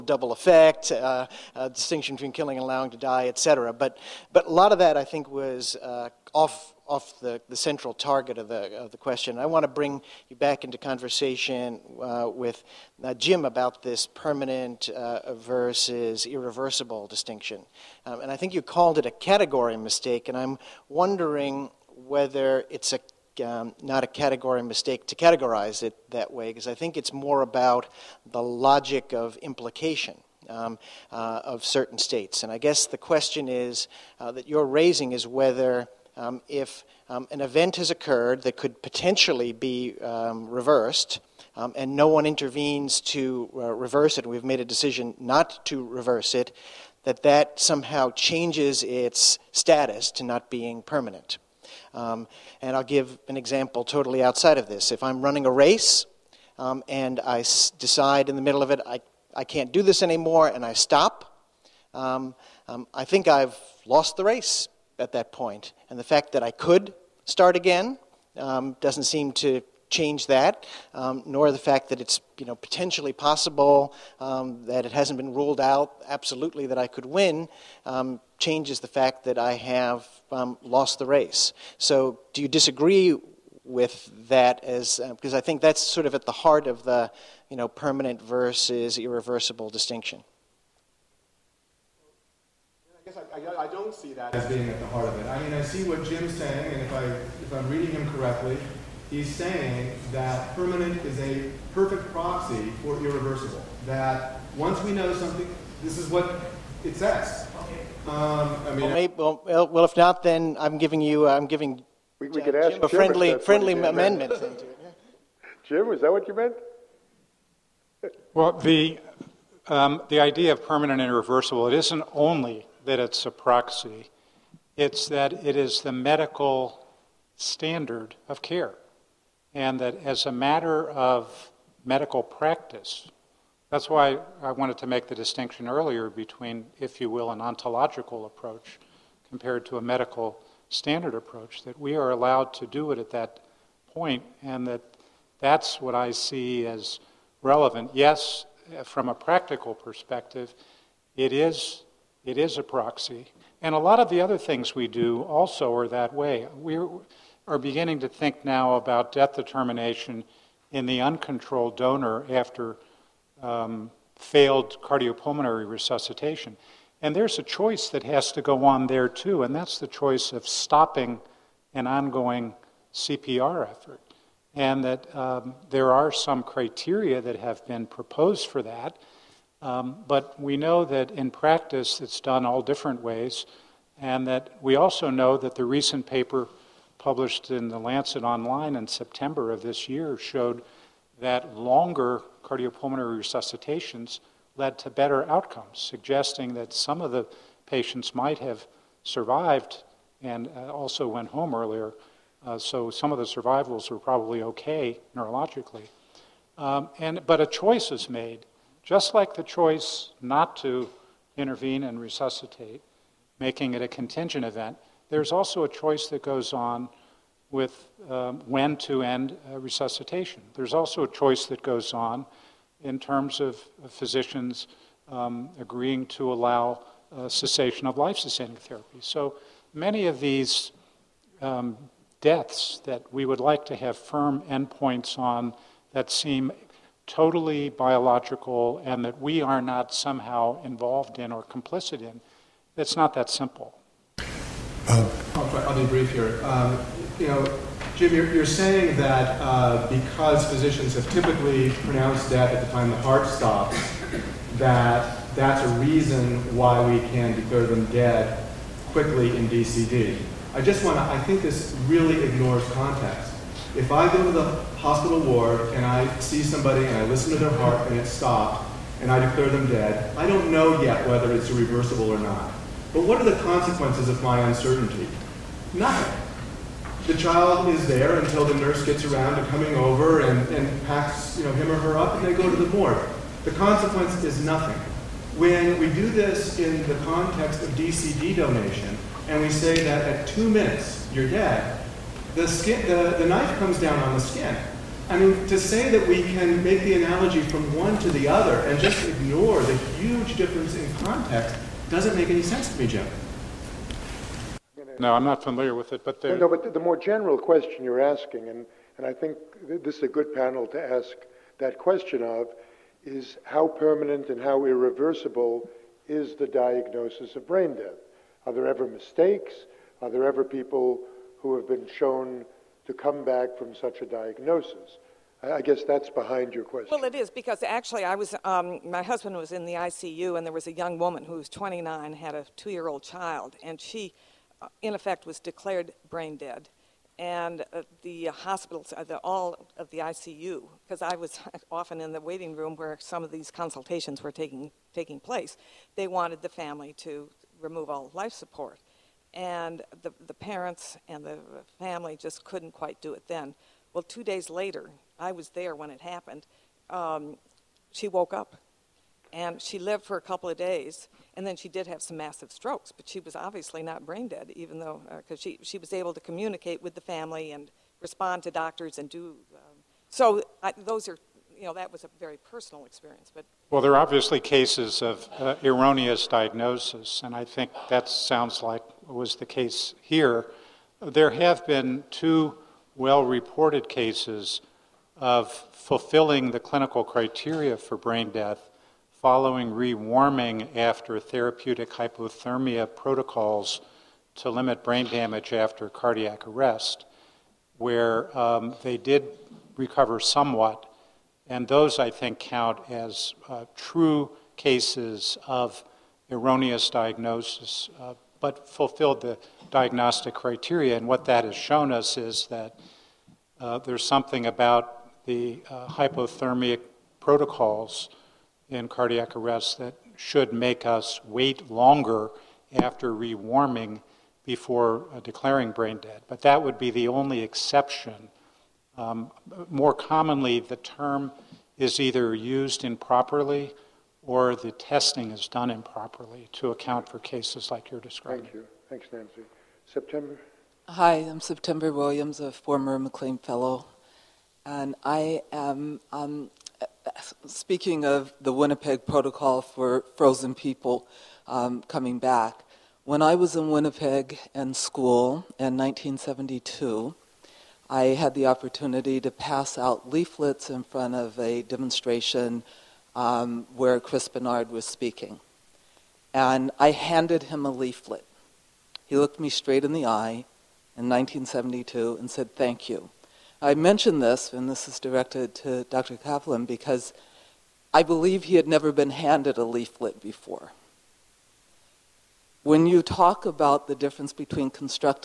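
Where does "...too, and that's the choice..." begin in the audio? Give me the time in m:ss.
2:49.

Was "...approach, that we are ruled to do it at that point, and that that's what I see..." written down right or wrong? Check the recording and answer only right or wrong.
wrong.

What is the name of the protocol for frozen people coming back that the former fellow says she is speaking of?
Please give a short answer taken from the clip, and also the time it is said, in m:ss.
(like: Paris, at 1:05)
Winnipeg Protocol, at 7:28.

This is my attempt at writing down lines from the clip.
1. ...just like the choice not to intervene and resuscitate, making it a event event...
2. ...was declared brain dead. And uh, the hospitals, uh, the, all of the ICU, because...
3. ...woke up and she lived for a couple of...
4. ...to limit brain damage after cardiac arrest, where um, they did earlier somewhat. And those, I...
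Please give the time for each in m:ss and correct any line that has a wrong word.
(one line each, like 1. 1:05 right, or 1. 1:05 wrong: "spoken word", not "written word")
1. 3:28 wrong: "contingent", not "event"
2. 5:35 right
3. 5:58 right
4. 6:34 wrong: "recover", not "earlier".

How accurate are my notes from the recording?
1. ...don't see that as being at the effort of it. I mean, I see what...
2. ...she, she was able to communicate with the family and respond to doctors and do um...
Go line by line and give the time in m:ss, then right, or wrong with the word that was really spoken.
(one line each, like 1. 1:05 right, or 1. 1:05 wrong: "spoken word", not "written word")
1. 1:33 wrong: "heart", not "effort"
2. 6:05 right.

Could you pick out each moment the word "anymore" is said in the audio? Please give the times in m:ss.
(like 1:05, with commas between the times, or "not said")
1:00.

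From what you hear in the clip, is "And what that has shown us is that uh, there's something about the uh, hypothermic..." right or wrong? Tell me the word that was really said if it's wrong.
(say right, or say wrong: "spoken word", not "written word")
right.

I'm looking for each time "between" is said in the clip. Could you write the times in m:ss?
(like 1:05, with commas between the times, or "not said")
0:02, 2:16, 8:04.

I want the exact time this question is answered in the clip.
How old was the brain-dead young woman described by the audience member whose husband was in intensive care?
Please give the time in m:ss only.
5:31.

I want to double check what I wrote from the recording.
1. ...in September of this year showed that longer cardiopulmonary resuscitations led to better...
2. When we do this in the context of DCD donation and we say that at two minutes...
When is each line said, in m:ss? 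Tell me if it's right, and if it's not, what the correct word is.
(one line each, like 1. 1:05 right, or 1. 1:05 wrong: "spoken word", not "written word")
1. 3:08 right
2. 4:45 right.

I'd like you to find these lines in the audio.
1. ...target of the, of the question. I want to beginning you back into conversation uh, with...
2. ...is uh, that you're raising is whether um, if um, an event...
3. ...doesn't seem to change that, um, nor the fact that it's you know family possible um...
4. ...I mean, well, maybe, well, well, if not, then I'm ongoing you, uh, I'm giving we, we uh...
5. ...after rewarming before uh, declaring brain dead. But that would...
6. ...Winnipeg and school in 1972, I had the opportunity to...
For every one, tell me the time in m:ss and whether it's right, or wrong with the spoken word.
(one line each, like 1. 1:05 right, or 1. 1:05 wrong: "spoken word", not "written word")
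1. 0:07 wrong: "bring", not "beginning"
2. 0:33 right
3. 1:08 wrong: "potentially", not "family"
4. 1:48 wrong: "giving", not "ongoing"
5. 7:02 right
6. 7:33 right.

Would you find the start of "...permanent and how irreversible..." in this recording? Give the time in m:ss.
5:13.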